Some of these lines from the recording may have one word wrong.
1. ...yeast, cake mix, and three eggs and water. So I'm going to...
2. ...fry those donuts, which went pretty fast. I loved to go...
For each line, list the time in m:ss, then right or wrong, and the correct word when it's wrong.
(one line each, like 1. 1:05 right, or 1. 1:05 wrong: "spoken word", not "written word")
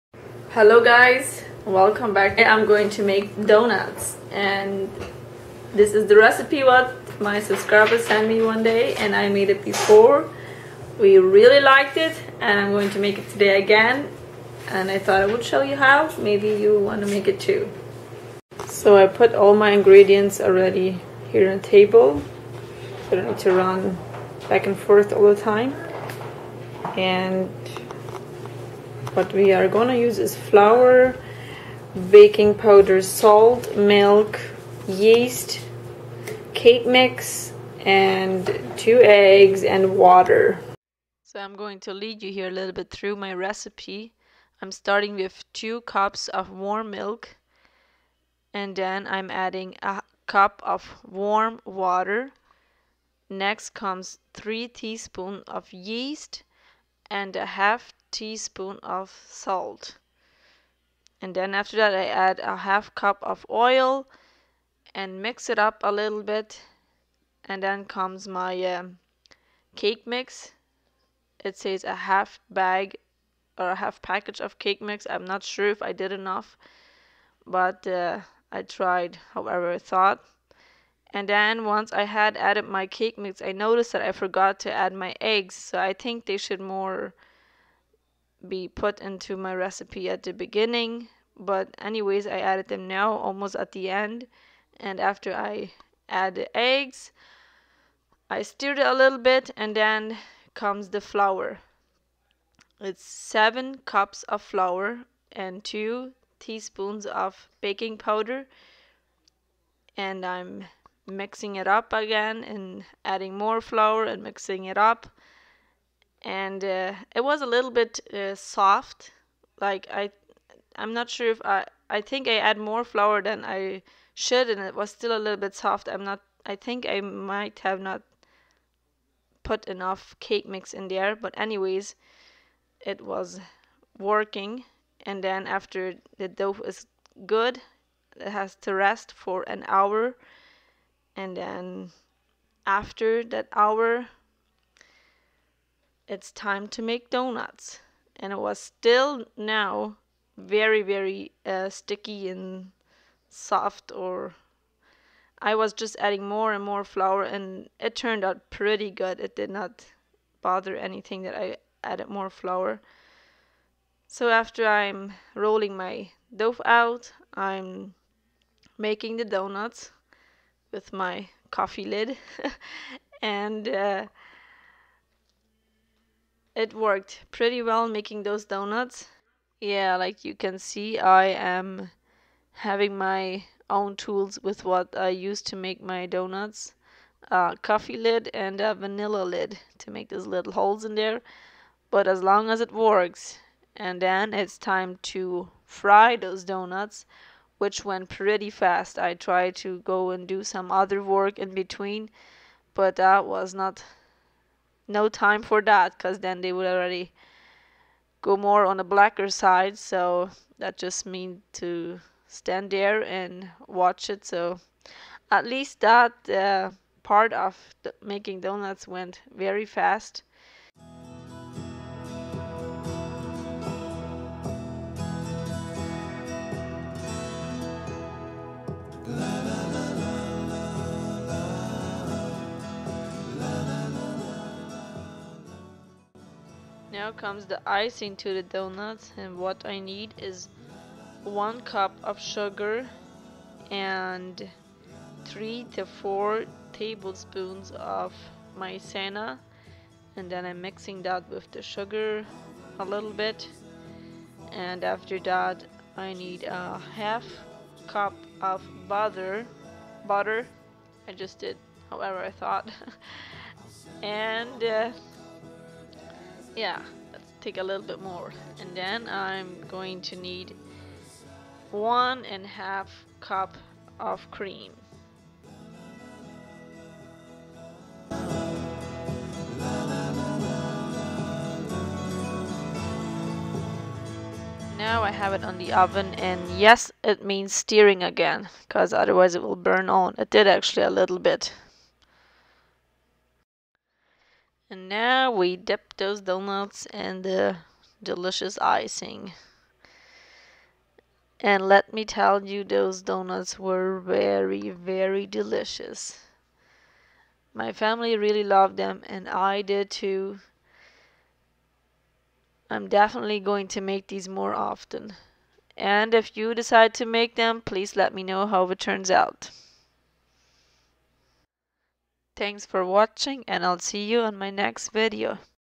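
1. 0:34 wrong: "two", not "three"
2. 3:15 wrong: "tried", not "loved".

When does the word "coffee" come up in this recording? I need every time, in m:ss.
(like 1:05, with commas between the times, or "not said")
2:51, 3:07.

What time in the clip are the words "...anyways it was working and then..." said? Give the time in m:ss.
2:11.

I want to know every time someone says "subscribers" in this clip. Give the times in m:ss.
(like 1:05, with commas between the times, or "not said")
0:07.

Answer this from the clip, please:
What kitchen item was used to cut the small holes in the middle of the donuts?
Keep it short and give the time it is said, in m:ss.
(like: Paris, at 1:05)
vanilla lid, at 3:08.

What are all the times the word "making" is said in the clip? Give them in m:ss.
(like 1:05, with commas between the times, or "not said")
2:48, 2:57, 3:38.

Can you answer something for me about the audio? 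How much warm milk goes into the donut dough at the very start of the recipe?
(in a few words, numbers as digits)
2 cups.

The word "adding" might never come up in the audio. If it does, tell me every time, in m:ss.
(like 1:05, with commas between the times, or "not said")
0:49, 1:53, 2:35.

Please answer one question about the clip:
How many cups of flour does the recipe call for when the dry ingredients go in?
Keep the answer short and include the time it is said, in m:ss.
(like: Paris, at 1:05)
7 cups, at 1:43.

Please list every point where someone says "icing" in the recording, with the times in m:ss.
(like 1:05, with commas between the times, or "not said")
3:57, 4:58.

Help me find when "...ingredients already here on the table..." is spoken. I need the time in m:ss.
0:19.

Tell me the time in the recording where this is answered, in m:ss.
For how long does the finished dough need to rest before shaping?
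2:19.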